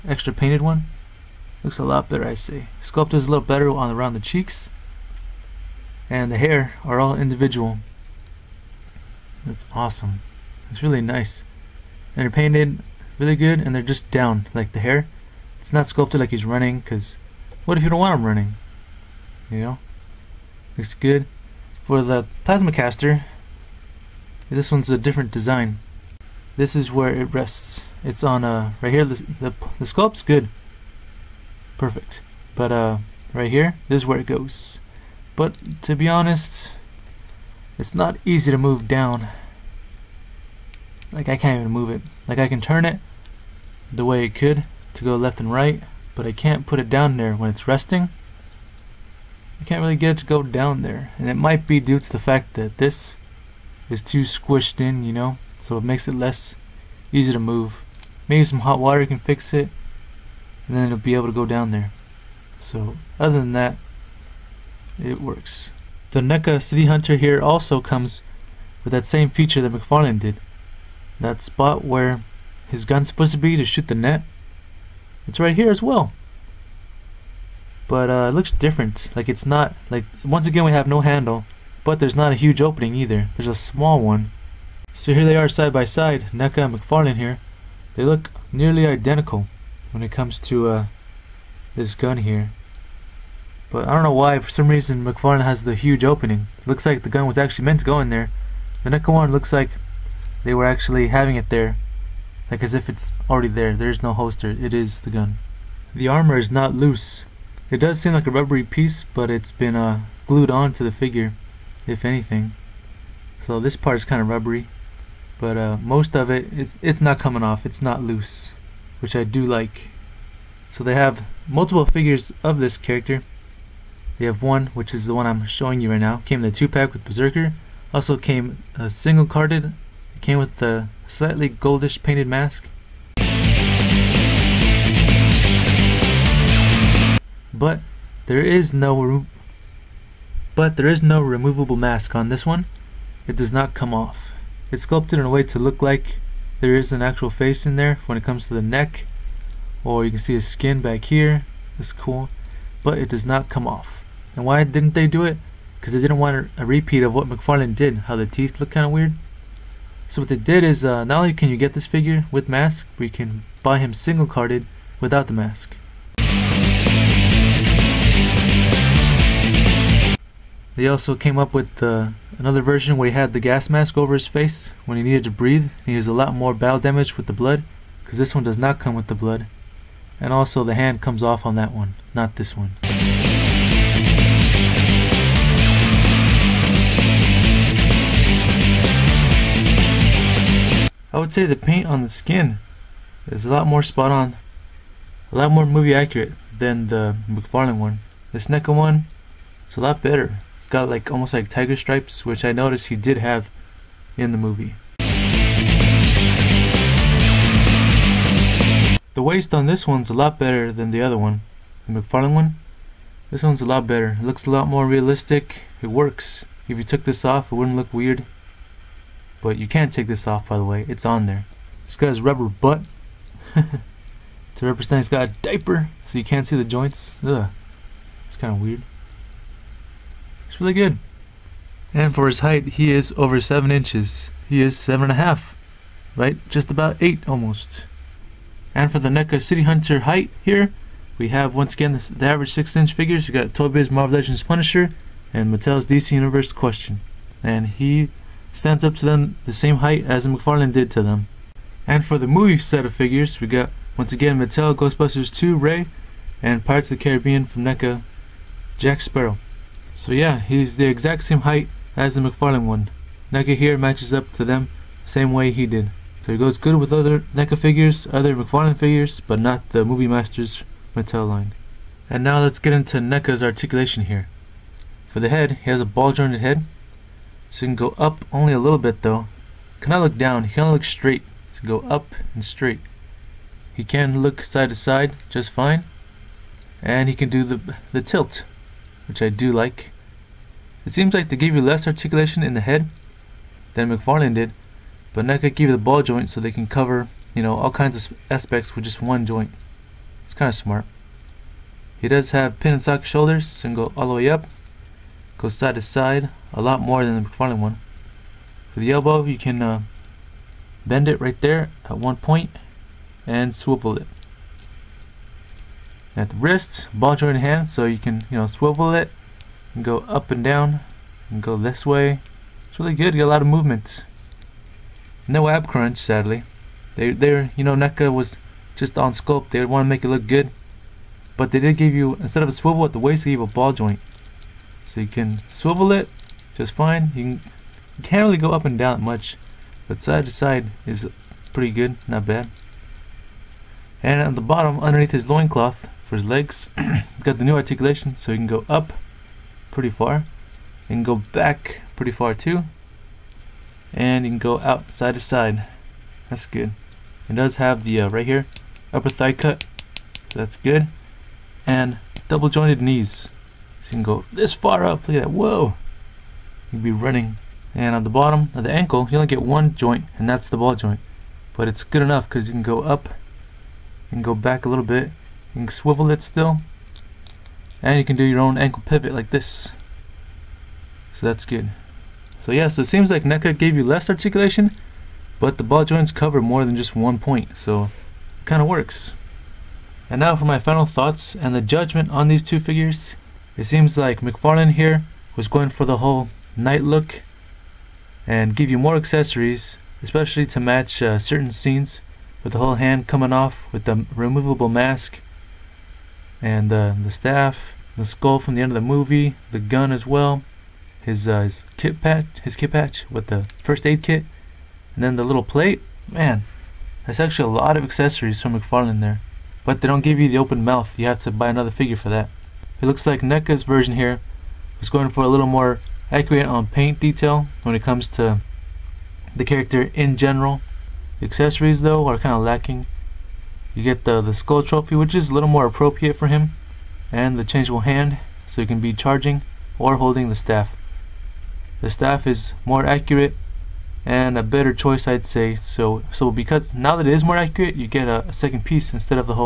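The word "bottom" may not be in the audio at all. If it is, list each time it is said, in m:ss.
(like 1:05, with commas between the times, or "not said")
5:44, 6:08.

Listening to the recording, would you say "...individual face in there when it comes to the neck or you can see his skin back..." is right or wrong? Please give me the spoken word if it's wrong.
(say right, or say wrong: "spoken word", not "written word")
wrong: "actual", not "individual".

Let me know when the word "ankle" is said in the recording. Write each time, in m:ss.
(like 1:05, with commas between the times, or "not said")
6:08, 6:18.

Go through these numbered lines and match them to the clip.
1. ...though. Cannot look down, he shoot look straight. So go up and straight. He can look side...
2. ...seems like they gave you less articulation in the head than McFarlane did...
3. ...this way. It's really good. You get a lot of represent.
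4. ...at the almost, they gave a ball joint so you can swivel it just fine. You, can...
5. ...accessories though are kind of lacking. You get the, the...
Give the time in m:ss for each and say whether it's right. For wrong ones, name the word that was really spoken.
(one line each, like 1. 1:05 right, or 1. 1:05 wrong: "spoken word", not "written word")
1. 4:39 wrong: "cannot", not "shoot"
2. 4:50 right
3. 5:21 wrong: "movement", not "represent"
4. 5:32 wrong: "waist", not "almost"
5. 7:11 right.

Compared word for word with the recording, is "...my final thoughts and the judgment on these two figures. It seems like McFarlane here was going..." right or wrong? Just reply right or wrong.
right.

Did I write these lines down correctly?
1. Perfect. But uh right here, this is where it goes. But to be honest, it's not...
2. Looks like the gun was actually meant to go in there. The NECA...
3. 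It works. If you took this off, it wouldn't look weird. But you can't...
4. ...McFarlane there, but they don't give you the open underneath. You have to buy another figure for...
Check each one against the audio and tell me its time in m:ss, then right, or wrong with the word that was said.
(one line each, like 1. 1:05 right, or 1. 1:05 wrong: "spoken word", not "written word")
1. 0:31 right
2. 1:36 right
3. 3:35 right
4. 6:58 wrong: "mouth", not "underneath".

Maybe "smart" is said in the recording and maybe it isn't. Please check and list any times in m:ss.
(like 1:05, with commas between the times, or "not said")
5:00.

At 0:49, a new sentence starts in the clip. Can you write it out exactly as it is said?
I can't really get it to go down there.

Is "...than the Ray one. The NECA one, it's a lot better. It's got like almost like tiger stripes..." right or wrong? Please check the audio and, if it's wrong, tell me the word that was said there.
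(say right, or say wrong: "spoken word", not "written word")
wrong: "McFarlane", not "Ray".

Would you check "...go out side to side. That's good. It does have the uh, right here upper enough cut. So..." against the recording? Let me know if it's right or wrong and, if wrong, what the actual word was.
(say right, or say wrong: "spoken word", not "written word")
wrong: "thigh", not "enough".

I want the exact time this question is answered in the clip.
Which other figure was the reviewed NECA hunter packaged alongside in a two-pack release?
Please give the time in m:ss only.
2:07.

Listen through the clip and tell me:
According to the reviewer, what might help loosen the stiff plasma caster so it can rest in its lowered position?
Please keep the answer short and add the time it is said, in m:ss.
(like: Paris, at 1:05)
Hot water, at 0:58.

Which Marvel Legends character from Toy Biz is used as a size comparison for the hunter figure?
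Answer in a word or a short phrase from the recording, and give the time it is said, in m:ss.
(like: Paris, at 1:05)
Punisher, at 4:04.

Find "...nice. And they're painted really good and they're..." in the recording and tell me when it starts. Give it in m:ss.
0:11.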